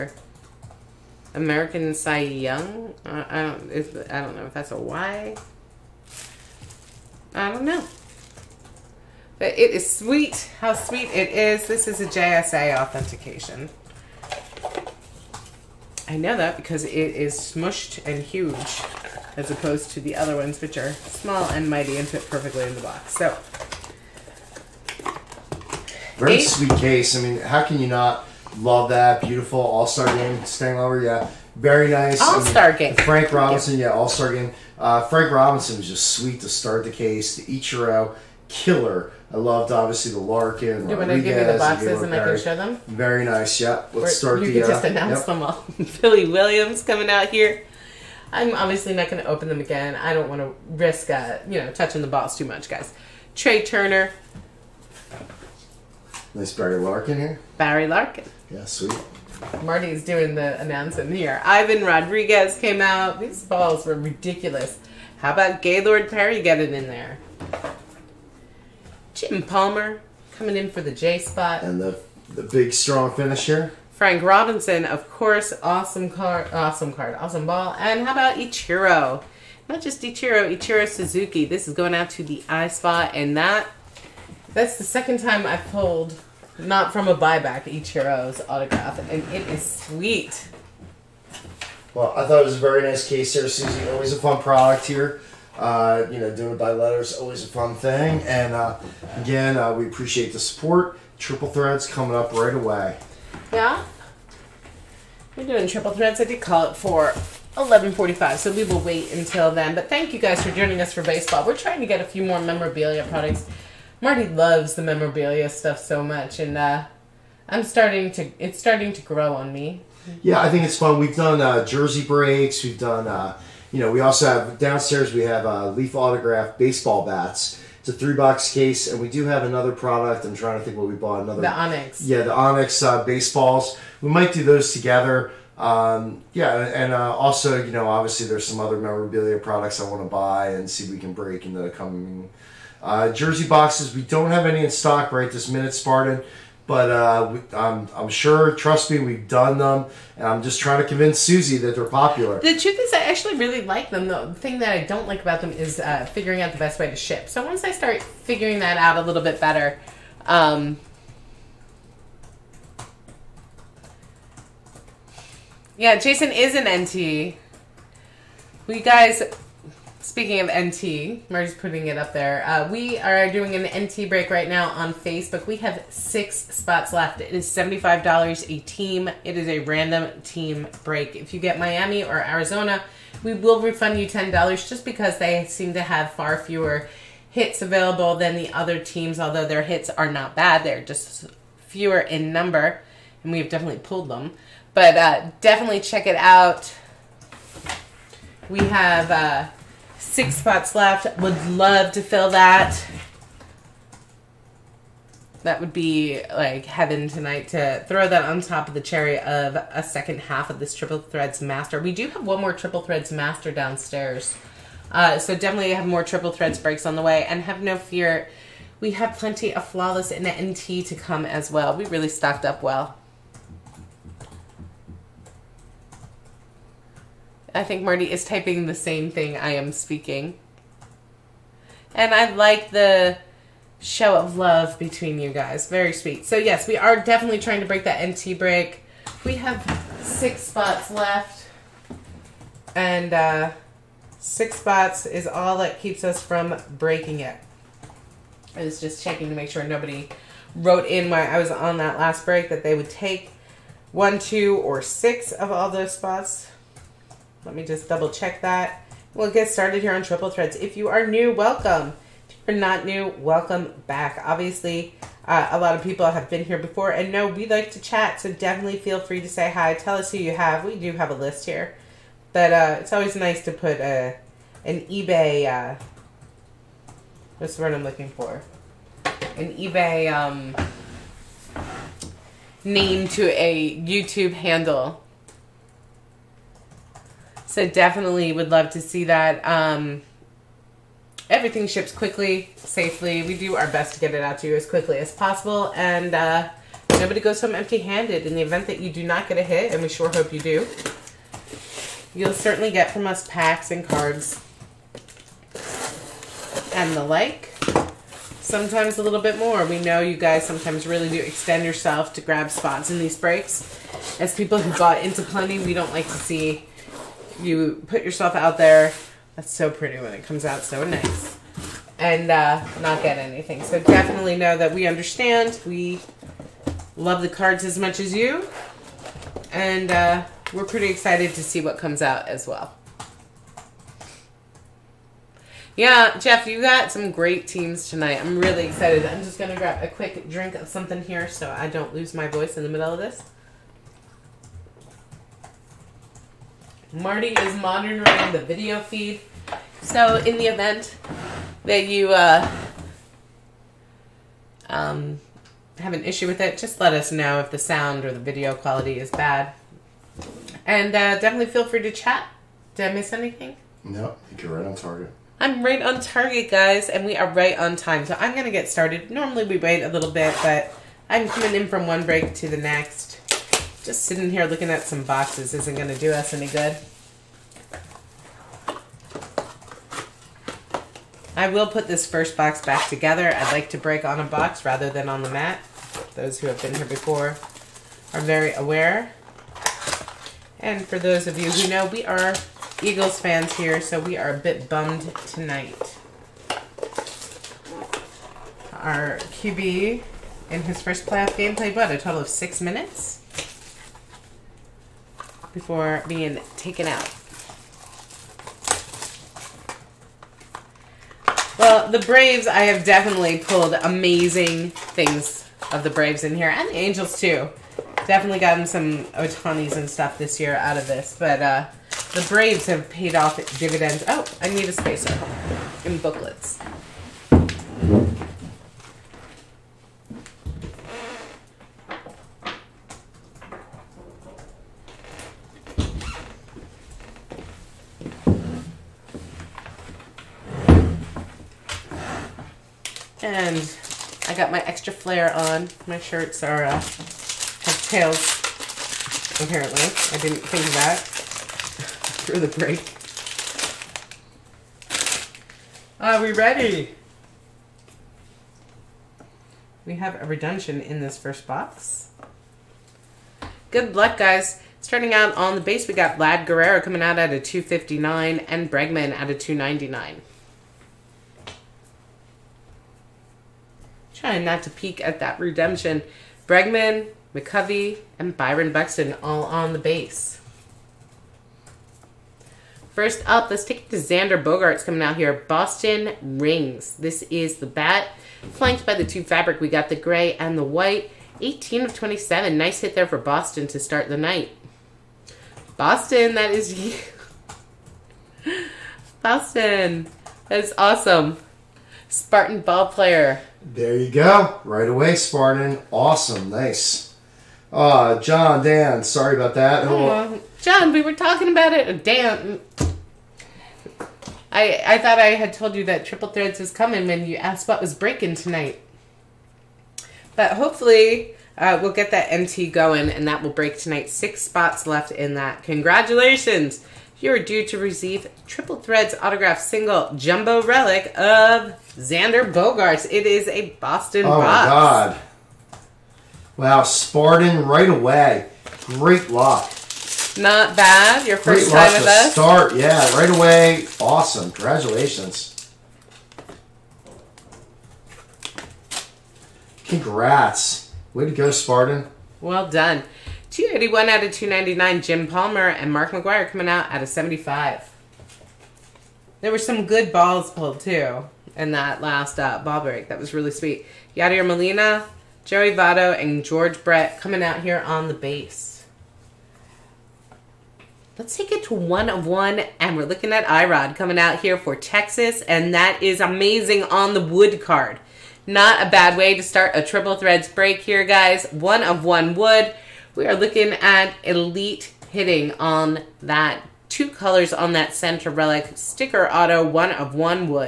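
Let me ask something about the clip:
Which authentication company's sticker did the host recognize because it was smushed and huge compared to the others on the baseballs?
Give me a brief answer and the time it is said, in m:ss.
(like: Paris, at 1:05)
JSA, at 0:12.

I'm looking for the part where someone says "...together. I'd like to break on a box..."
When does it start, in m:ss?
6:22.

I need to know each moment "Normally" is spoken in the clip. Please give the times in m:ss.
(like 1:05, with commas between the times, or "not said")
6:09.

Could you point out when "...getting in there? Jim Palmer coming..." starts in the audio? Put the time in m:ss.
1:06.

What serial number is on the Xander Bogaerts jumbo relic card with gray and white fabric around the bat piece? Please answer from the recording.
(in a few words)
18 of 27.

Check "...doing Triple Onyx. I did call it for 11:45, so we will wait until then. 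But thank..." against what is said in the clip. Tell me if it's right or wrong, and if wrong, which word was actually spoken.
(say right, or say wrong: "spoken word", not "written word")
wrong: "Threads", not "Onyx".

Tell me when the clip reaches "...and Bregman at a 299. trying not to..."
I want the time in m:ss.
7:48.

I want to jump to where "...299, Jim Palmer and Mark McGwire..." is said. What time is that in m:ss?
9:14.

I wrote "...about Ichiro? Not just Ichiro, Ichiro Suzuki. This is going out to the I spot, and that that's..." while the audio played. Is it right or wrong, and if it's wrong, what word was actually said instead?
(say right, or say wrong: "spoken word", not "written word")
right.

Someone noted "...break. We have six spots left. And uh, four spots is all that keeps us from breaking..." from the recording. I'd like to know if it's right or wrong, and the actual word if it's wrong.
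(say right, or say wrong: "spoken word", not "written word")
wrong: "six", not "four".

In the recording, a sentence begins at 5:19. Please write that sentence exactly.
That's so pretty when it comes out so nice.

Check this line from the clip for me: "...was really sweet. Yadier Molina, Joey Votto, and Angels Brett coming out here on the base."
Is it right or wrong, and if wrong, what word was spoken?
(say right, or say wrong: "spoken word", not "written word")
wrong: "George", not "Angels".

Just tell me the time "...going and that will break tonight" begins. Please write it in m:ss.
8:42.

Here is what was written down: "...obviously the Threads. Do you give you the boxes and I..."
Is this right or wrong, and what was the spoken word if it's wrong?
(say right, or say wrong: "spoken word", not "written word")
wrong: "Larkin", not "Threads".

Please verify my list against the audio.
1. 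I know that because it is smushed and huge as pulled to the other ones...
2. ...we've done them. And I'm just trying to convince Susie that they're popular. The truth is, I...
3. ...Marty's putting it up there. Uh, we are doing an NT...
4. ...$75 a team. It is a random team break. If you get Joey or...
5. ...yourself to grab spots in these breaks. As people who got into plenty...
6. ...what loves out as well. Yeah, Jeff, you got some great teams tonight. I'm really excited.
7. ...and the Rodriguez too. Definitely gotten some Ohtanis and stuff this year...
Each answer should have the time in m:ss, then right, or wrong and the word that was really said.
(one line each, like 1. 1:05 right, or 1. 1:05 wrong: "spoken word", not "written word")
1. 0:16 wrong: "opposed", not "pulled"
2. 2:28 right
3. 2:51 right
4. 2:57 wrong: "Miami", not "Joey"
5. 5:11 right
6. 5:31 wrong: "comes", not "loves"
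7. 6:56 wrong: "Angels", not "Rodriguez".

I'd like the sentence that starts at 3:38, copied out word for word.
We have plenty of Flawless and NT to come as well.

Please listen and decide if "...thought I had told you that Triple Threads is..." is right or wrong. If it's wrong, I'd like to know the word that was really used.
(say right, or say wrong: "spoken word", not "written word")
right.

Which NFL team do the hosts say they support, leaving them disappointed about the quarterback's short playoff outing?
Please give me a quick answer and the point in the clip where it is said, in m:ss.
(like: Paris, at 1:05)
Eagles, at 6:32.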